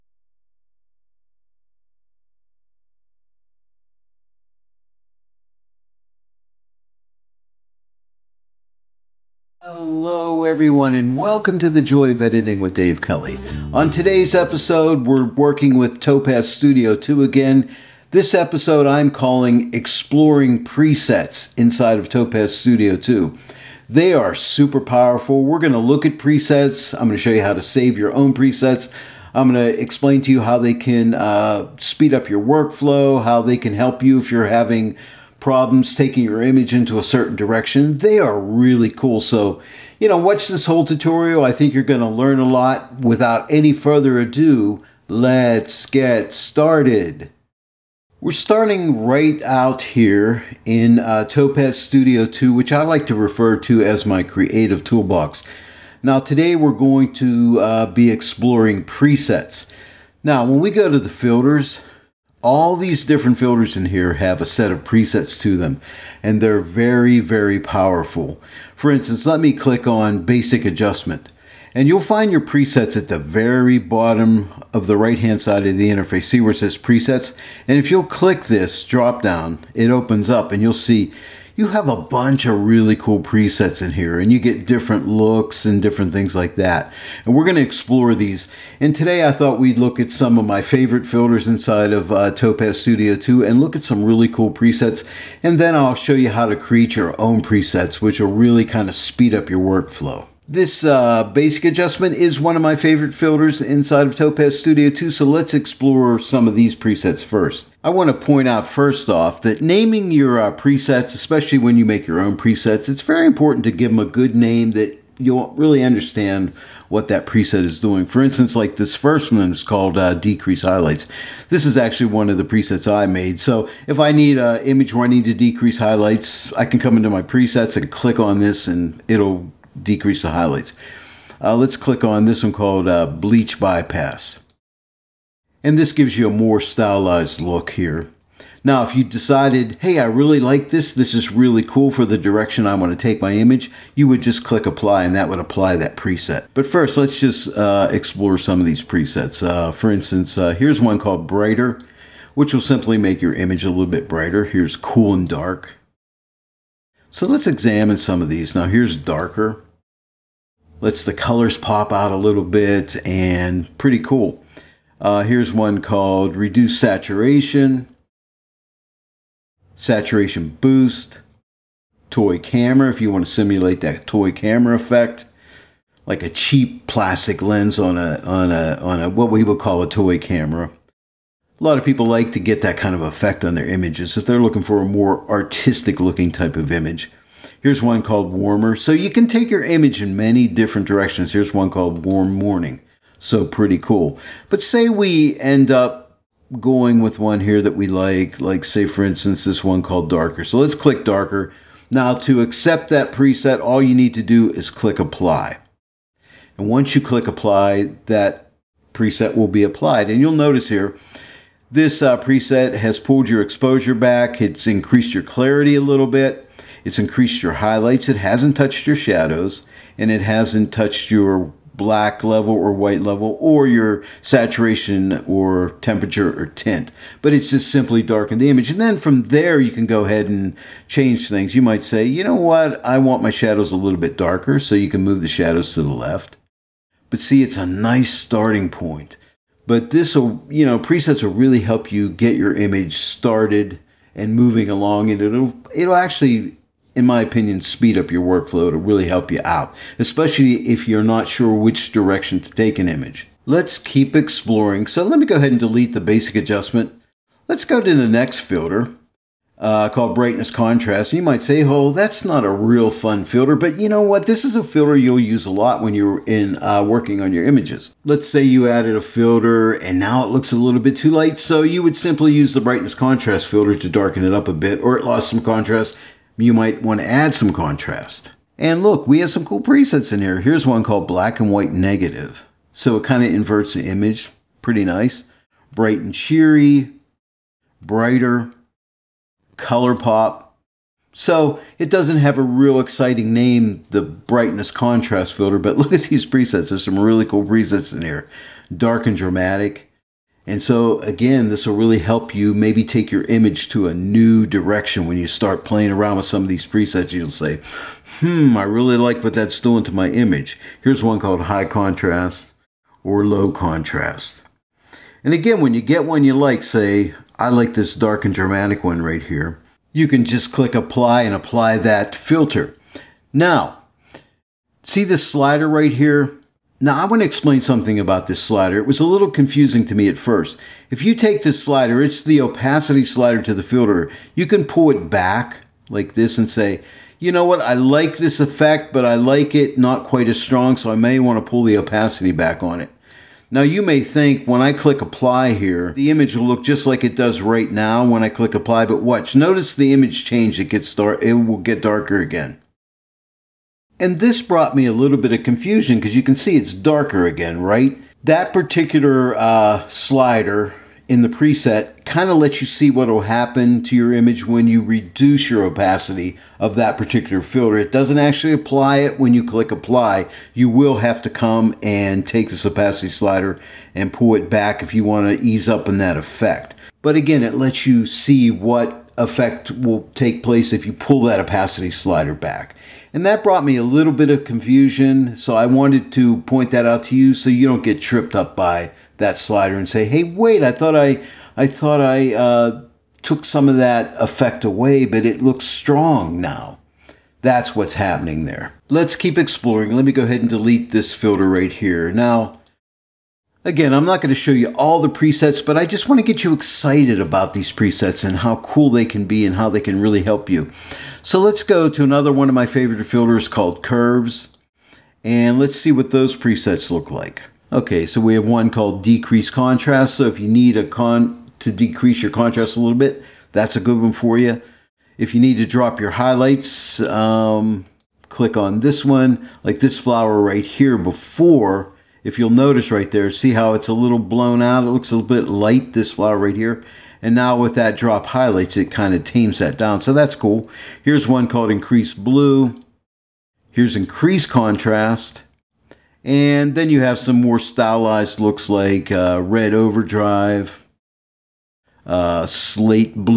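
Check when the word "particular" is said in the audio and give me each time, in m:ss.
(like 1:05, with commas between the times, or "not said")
5:58, 6:06.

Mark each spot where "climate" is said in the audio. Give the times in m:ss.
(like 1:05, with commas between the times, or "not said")
not said.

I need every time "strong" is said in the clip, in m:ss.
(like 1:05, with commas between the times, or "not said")
5:40, 6:35.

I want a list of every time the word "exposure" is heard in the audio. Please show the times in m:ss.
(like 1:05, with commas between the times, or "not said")
3:33.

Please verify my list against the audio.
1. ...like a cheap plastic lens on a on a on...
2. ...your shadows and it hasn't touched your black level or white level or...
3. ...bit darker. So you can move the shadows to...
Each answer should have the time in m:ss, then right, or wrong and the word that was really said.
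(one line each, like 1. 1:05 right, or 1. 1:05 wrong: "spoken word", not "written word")
1. 2:56 right
2. 3:38 right
3. 3:53 right.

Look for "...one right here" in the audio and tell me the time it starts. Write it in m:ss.
5:18.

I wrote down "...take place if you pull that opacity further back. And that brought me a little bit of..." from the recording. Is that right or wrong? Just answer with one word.
wrong.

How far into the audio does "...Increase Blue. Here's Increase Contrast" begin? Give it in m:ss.
7:21.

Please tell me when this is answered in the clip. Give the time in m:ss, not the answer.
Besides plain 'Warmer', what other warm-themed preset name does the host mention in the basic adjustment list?
3:12.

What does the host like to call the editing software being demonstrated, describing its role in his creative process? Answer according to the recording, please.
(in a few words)
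Creative toolbox.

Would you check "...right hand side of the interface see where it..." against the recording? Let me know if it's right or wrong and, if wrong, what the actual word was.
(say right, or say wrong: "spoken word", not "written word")
right.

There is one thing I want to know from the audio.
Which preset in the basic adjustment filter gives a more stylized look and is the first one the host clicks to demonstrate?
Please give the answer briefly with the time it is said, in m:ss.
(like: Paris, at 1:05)
Bleach Bypass, at 2:13.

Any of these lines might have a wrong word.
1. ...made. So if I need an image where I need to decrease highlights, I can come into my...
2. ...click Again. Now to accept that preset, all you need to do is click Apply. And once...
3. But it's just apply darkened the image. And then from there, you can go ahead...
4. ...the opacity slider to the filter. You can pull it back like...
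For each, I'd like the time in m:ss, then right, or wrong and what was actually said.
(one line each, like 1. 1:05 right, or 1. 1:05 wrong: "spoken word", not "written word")
1. 2:03 right
2. 3:20 wrong: "Darker", not "Again"
3. 3:47 wrong: "simply", not "apply"
4. 5:32 right.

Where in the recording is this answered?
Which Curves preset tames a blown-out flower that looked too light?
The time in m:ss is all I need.
7:17.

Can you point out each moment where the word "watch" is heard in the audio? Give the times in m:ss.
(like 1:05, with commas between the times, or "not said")
0:40, 5:49.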